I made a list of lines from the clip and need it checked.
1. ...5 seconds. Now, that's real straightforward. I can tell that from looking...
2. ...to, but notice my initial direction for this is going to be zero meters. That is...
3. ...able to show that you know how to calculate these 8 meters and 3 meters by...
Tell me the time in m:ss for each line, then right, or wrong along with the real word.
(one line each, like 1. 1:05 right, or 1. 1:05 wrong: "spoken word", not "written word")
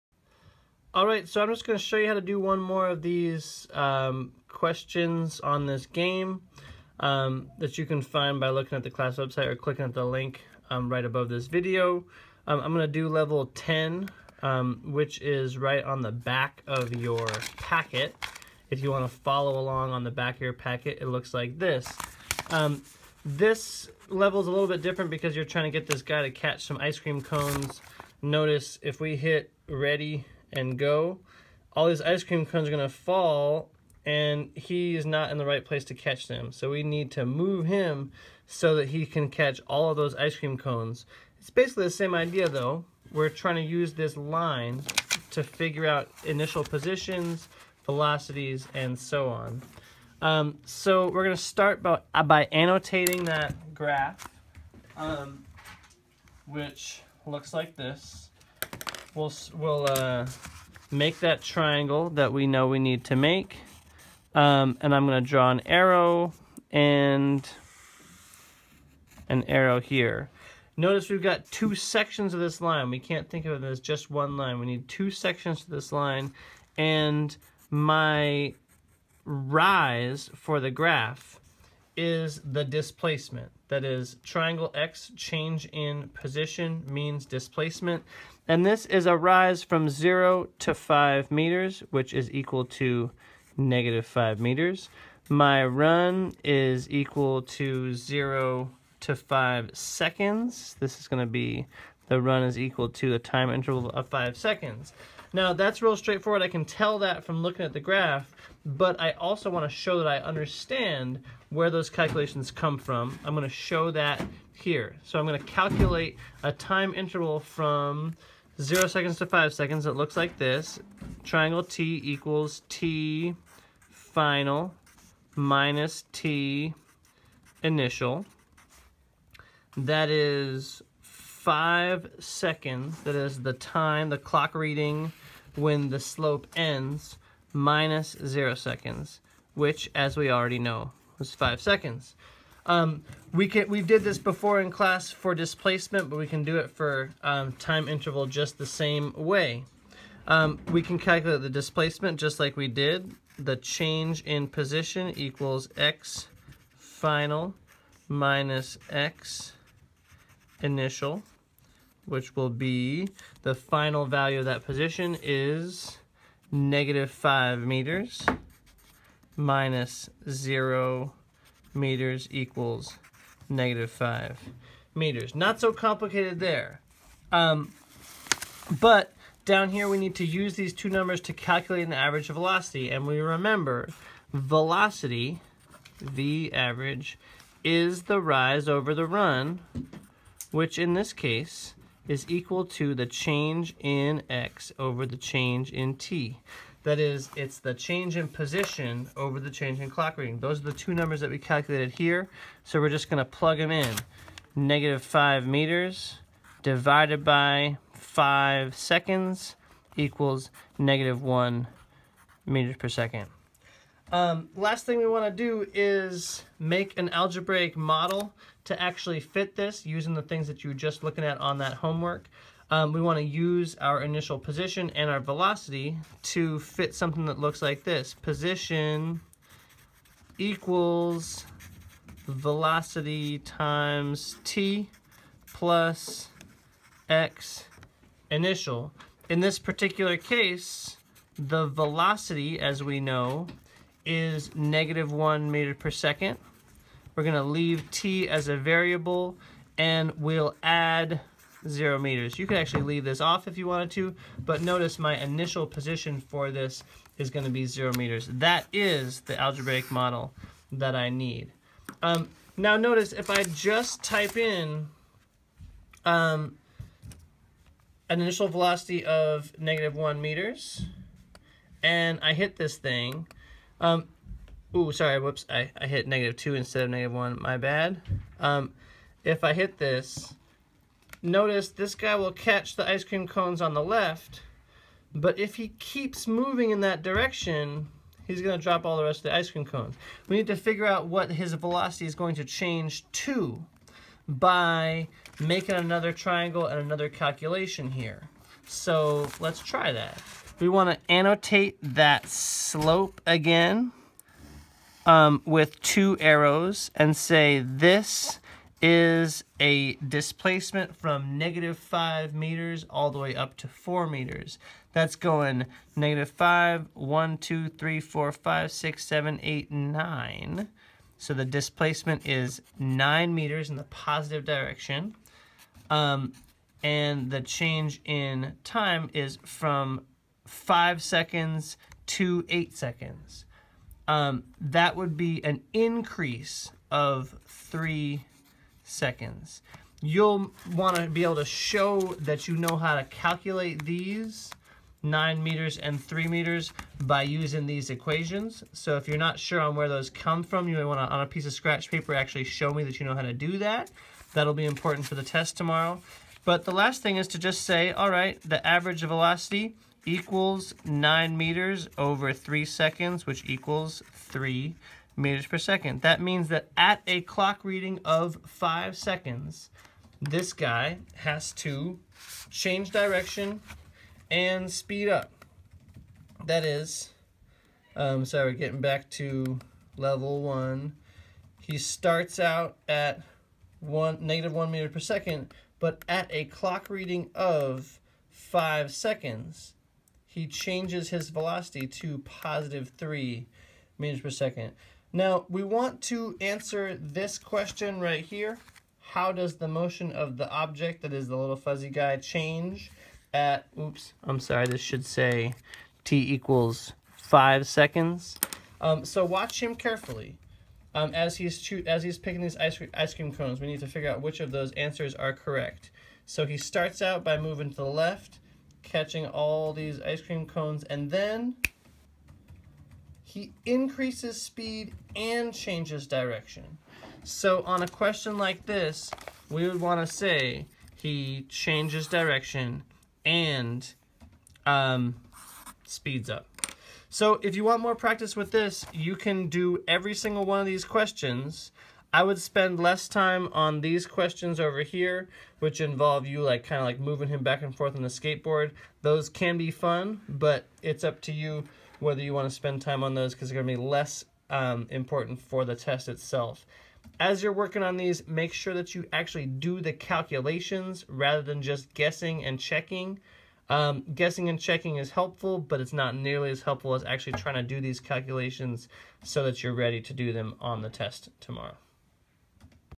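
1. 1:44 right
2. 4:13 wrong: "position", not "direction"
3. 5:41 wrong: "9", not "8".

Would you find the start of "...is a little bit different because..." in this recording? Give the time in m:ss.
0:24.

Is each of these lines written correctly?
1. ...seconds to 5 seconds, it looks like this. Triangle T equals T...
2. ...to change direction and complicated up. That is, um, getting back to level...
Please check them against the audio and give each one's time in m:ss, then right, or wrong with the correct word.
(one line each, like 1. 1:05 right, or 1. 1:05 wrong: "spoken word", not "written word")
1. 1:58 right
2. 6:11 wrong: "speed", not "complicated".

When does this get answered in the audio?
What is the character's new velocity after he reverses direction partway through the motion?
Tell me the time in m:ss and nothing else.
6:04.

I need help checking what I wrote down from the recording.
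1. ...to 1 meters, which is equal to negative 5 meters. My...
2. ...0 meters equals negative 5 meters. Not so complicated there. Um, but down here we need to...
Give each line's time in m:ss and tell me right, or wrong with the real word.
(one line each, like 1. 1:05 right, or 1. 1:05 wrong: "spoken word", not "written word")
1. 1:30 wrong: "5", not "1"
2. 2:50 right.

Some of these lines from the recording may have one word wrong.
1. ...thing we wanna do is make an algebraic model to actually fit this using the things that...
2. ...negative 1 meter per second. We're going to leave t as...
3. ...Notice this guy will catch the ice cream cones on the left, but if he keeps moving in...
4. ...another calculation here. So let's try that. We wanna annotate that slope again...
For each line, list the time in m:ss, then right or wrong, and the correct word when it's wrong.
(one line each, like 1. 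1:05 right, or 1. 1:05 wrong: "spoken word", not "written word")
1. 3:34 right
2. 4:04 right
3. 4:41 right
4. 4:56 right.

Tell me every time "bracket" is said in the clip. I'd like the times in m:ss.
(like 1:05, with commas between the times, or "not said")
not said.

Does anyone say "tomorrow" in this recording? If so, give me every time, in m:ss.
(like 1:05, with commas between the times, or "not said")
5:55, 7:51.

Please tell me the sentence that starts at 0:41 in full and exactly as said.
It's basically the same idea though.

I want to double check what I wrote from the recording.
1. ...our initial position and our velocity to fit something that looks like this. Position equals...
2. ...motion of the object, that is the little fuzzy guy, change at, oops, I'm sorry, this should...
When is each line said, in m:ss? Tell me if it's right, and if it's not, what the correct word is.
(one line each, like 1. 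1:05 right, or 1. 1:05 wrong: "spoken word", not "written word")
1. 3:43 right
2. 6:39 right.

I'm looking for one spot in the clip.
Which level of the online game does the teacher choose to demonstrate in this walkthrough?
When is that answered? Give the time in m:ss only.
0:13.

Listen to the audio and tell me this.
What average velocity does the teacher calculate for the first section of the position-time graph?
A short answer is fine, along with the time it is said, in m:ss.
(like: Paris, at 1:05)
-1 m/s, at 3:30.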